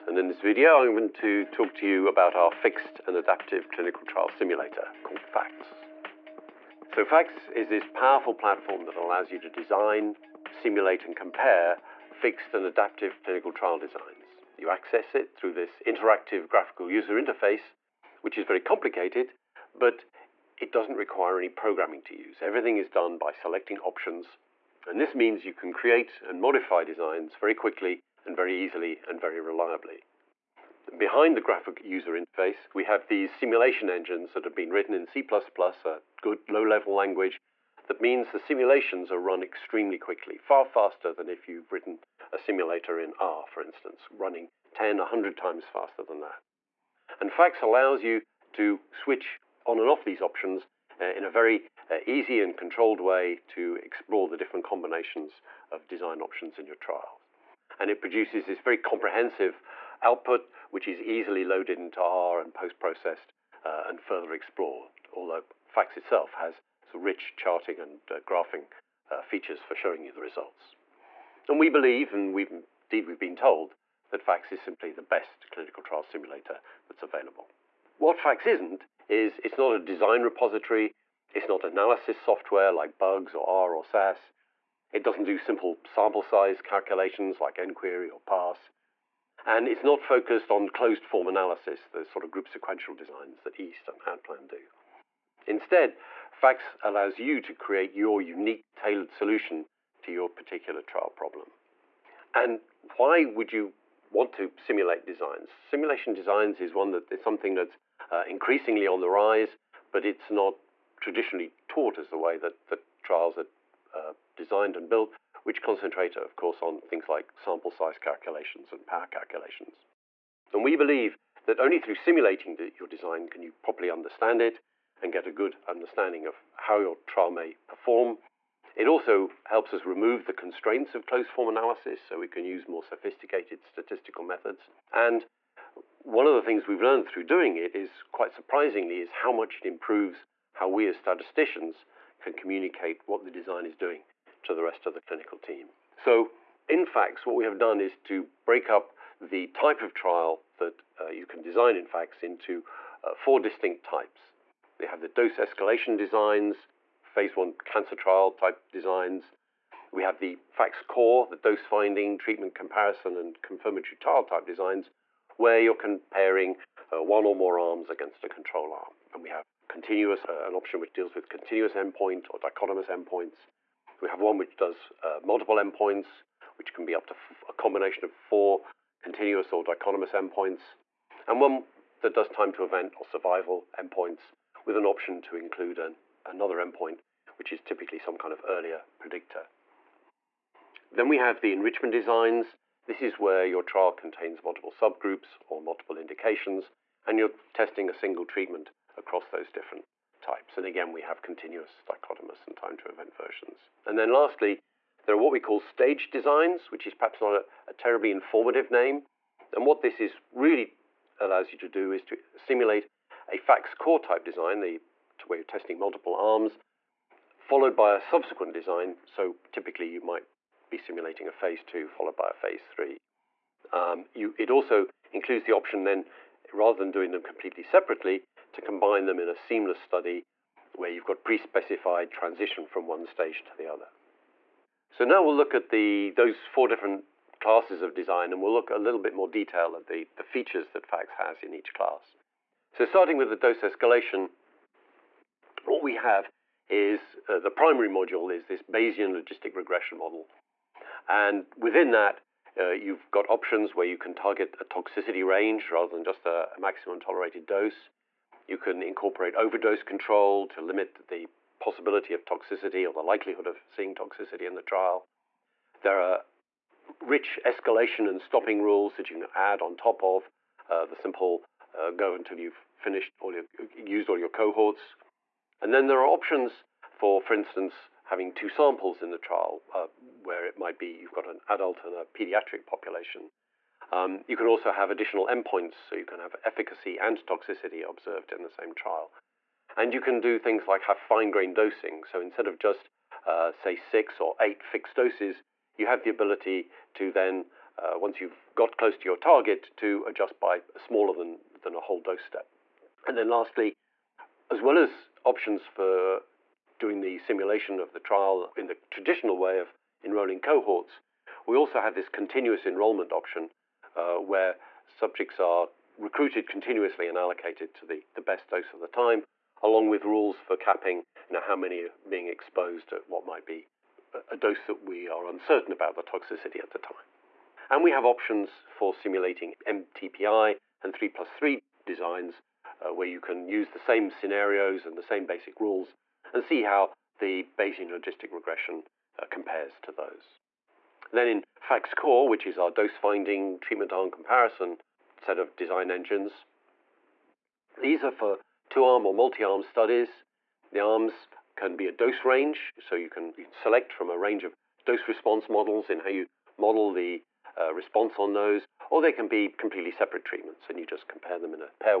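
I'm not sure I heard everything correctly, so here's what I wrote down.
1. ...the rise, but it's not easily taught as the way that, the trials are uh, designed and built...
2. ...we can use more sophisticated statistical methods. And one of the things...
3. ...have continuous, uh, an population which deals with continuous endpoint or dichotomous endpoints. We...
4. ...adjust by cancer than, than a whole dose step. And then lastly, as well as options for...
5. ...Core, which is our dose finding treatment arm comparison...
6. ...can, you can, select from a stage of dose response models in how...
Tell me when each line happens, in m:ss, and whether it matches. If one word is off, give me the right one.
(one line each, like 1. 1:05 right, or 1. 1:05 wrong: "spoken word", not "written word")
1. 1:48 wrong: "traditionally", not "easily"
2. 2:12 right
3. 2:49 wrong: "option", not "population"
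4. 5:00 wrong: "smaller", not "cancer"
5. 5:41 right
6. 5:53 wrong: "range", not "stage".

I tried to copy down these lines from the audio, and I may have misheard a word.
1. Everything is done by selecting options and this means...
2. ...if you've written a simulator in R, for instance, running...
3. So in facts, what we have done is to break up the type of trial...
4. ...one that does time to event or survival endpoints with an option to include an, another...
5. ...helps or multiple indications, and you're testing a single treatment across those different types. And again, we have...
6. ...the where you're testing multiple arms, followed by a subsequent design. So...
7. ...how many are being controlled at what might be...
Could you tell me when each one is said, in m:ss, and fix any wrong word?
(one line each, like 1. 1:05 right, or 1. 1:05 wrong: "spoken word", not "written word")
1. 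0:22 right
2. 0:41 right
3. 2:25 right
4. 3:01 right
5. 3:14 wrong: "subgroups", not "helps"
6. 3:34 right
7. 5:21 wrong: "exposed", not "controlled".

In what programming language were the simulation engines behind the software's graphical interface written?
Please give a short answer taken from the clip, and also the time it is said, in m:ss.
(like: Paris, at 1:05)
C++, at 0:35.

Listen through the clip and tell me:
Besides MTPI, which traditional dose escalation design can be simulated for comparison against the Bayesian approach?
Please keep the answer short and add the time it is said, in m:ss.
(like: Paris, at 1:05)
3 plus 3, at 5:30.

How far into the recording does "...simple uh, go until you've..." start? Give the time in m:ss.
4:30.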